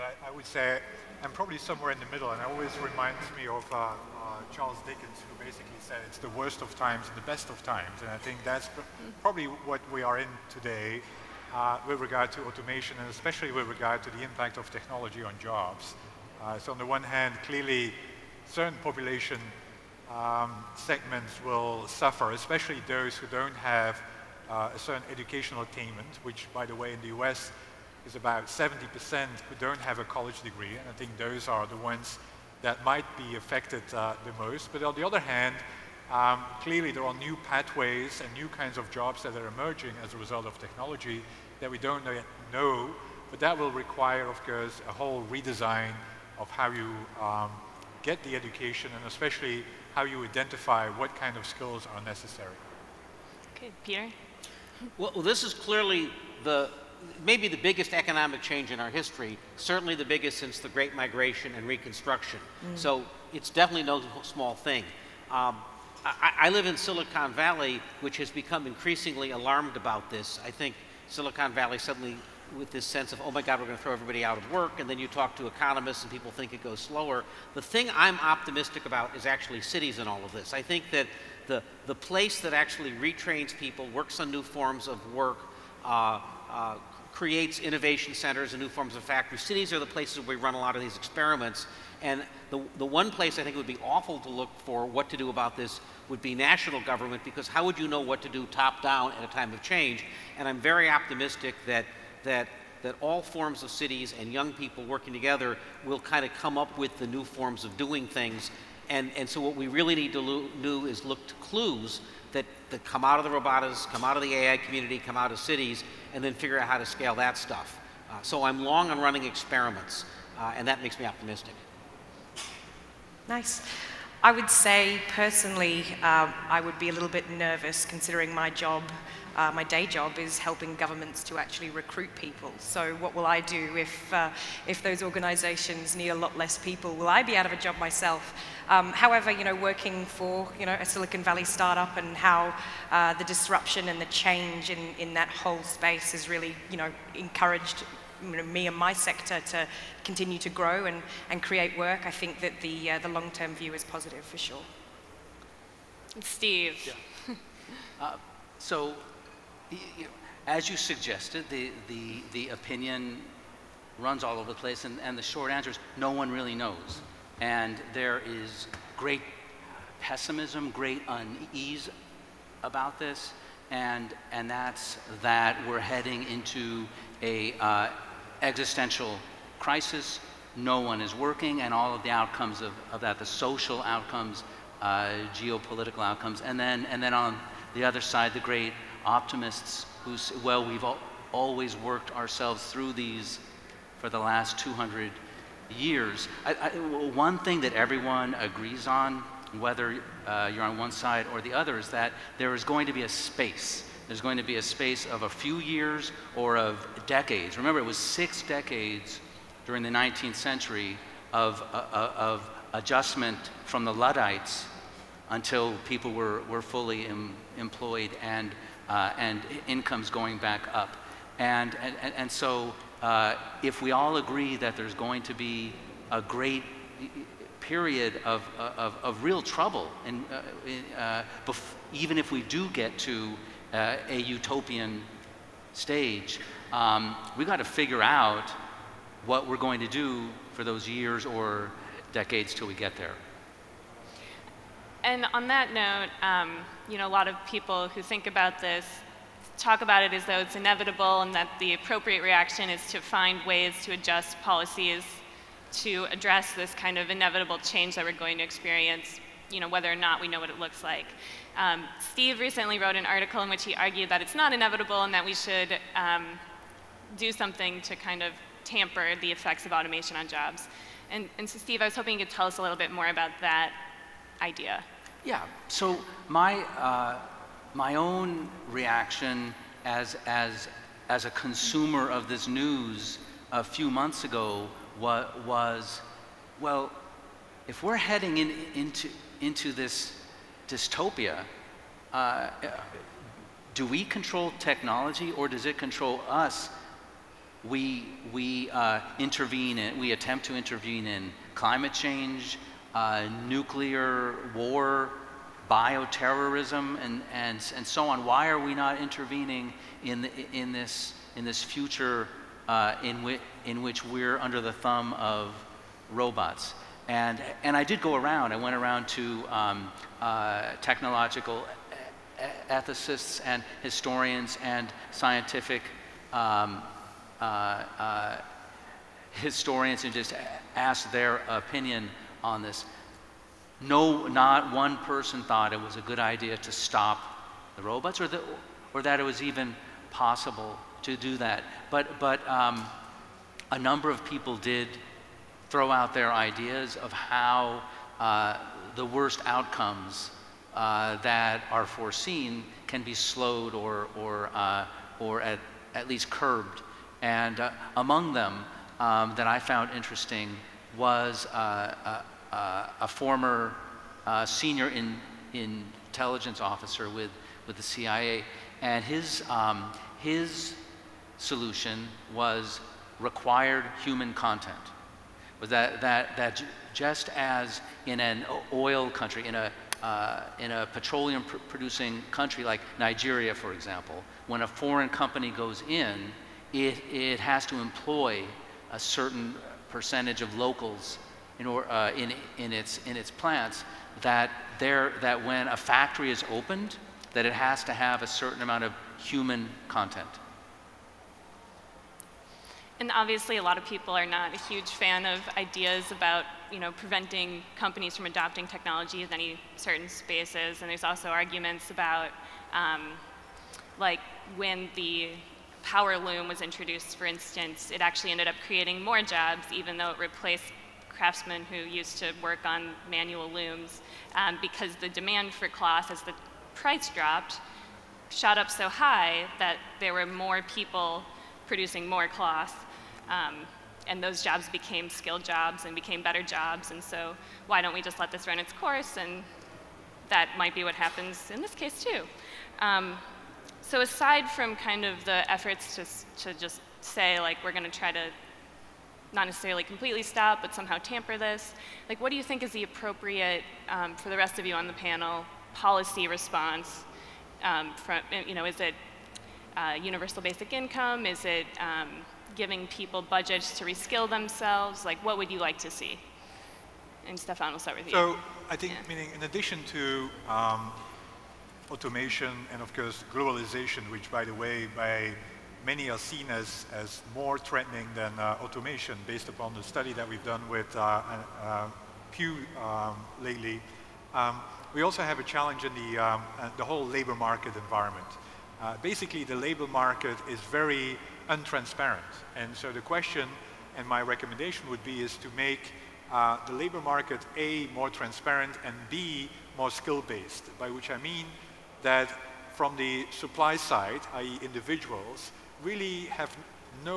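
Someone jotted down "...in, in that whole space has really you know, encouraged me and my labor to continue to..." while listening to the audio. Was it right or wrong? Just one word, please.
wrong.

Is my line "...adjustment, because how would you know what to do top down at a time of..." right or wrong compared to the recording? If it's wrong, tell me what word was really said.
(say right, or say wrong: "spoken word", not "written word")
wrong: "government", not "adjustment".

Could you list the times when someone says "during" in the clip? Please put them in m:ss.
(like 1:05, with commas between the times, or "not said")
3:29.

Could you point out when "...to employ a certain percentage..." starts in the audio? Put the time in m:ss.
6:27.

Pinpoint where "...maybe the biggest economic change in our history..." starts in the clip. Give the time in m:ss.
0:57.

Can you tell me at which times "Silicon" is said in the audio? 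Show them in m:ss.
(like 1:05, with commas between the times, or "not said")
1:06, 1:11, 2:20.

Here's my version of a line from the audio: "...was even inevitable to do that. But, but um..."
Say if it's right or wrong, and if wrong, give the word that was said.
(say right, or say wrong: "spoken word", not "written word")
wrong: "possible", not "inevitable".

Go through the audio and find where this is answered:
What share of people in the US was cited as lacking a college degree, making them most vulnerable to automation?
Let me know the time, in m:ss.
0:28.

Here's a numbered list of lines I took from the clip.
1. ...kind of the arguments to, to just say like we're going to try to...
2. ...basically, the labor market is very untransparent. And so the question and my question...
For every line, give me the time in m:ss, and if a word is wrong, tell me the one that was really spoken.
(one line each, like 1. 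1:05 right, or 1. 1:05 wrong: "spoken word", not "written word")
1. 7:24 wrong: "efforts", not "arguments"
2. 8:09 wrong: "recommendation", not "question".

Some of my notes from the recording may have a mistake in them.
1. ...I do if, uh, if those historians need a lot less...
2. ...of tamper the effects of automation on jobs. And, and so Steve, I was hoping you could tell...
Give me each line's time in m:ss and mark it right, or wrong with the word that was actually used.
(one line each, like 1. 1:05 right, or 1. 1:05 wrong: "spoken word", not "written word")
1. 2:13 wrong: "organizations", not "historians"
2. 4:28 right.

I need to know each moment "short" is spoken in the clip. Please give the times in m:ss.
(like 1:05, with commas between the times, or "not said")
2:45.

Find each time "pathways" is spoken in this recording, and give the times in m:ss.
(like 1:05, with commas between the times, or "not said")
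0:37.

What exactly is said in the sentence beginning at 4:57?
We, we uh, intervene in, we attempt to intervene in climate change, uh, nuclear war, bioterrorism, and, and, and so on.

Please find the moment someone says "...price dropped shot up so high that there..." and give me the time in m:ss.
7:06.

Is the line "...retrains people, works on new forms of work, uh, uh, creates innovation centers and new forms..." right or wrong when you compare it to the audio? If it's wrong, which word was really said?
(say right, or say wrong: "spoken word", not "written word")
right.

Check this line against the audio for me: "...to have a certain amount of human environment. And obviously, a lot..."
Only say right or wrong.
wrong.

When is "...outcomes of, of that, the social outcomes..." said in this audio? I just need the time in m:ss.
3:02.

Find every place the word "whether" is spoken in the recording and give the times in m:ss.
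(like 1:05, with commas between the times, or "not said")
3:19, 4:19.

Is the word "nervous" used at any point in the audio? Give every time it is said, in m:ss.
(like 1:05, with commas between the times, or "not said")
2:07.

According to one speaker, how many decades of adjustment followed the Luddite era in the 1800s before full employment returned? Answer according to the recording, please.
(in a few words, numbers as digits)
6.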